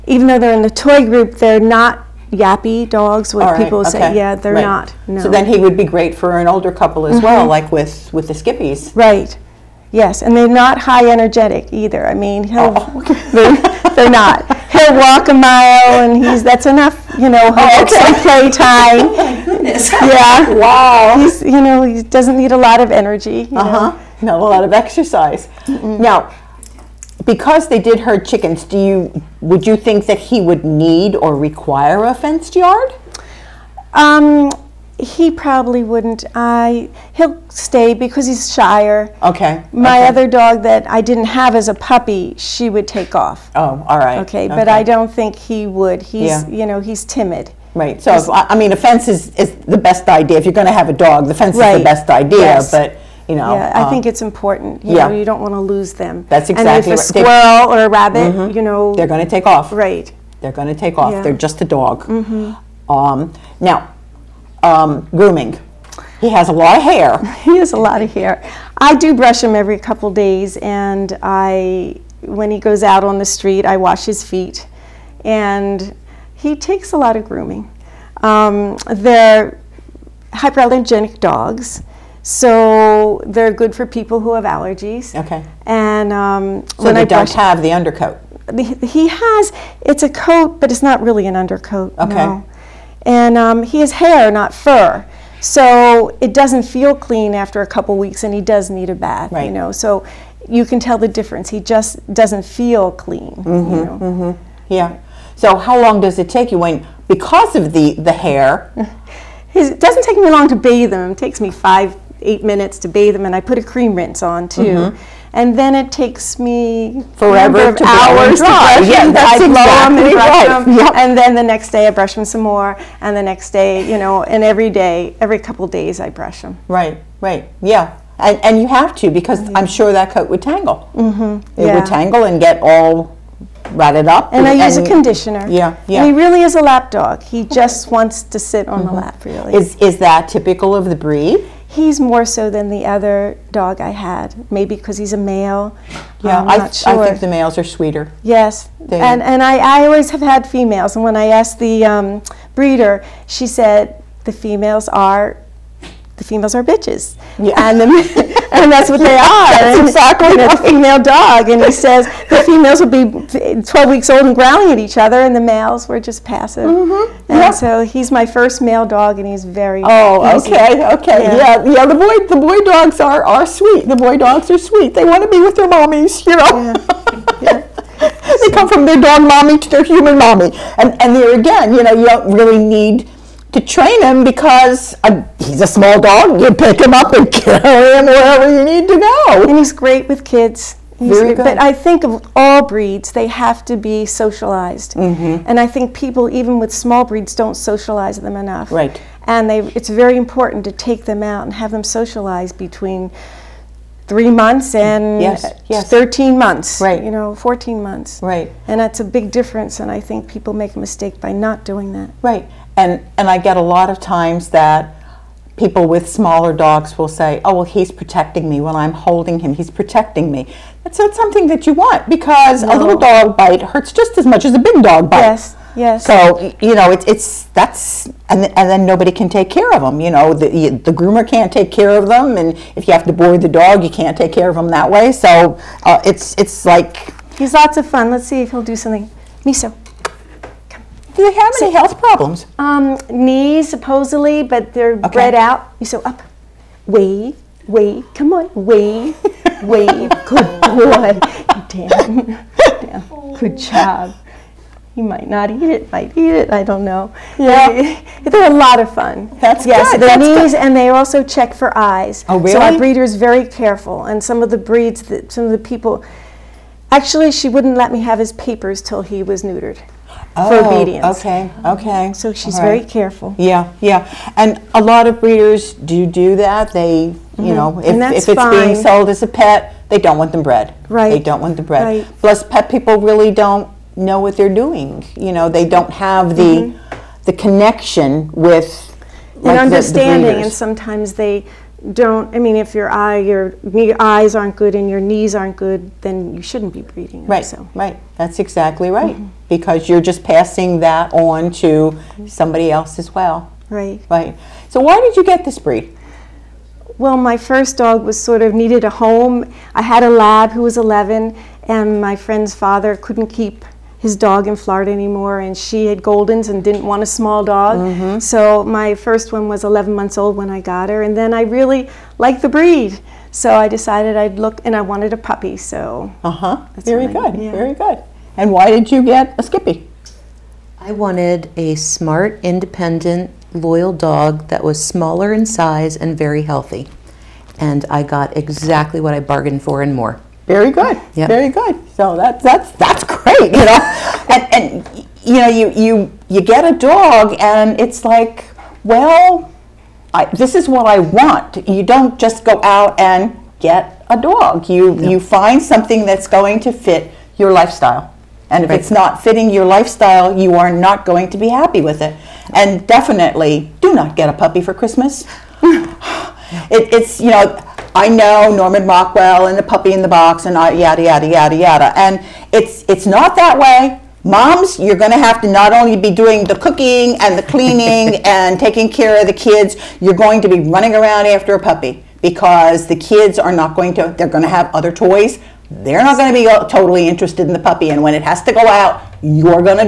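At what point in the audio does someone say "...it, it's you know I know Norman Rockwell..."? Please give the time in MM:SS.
06:05.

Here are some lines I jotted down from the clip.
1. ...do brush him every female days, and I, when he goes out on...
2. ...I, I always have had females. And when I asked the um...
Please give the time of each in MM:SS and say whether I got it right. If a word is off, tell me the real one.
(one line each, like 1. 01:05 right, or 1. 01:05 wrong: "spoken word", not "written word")
1. 01:08 wrong: "couple", not "female"
2. 02:29 right.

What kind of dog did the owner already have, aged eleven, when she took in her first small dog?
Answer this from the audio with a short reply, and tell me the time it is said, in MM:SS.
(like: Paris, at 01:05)
a lab, at 05:10.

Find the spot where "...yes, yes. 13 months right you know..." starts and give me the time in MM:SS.
03:25.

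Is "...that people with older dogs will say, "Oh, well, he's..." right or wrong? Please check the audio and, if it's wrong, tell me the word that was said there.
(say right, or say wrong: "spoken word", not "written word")
wrong: "smaller", not "older".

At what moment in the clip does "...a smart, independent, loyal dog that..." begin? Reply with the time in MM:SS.
05:31.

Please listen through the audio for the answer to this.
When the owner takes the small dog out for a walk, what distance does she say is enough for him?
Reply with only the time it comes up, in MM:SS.
00:15.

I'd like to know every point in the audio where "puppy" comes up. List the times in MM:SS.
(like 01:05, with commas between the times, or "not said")
00:41, 05:25, 06:04, 06:09, 06:21, 06:27.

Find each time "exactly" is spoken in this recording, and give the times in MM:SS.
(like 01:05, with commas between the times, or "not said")
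00:56, 01:59, 02:39, 04:58, 05:38.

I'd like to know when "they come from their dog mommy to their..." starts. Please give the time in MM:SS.
02:58.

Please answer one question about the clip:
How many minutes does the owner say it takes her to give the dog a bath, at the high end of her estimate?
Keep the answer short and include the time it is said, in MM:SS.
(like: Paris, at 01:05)
8, at 01:52.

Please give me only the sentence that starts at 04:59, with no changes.
Because you're just passing that on to mm-hmm.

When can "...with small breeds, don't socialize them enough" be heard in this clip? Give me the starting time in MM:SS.
03:16.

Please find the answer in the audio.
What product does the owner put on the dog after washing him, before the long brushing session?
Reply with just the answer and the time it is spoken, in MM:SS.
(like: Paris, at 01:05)
cream rinse, at 01:53.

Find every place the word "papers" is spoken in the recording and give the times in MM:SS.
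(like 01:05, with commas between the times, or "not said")
04:28.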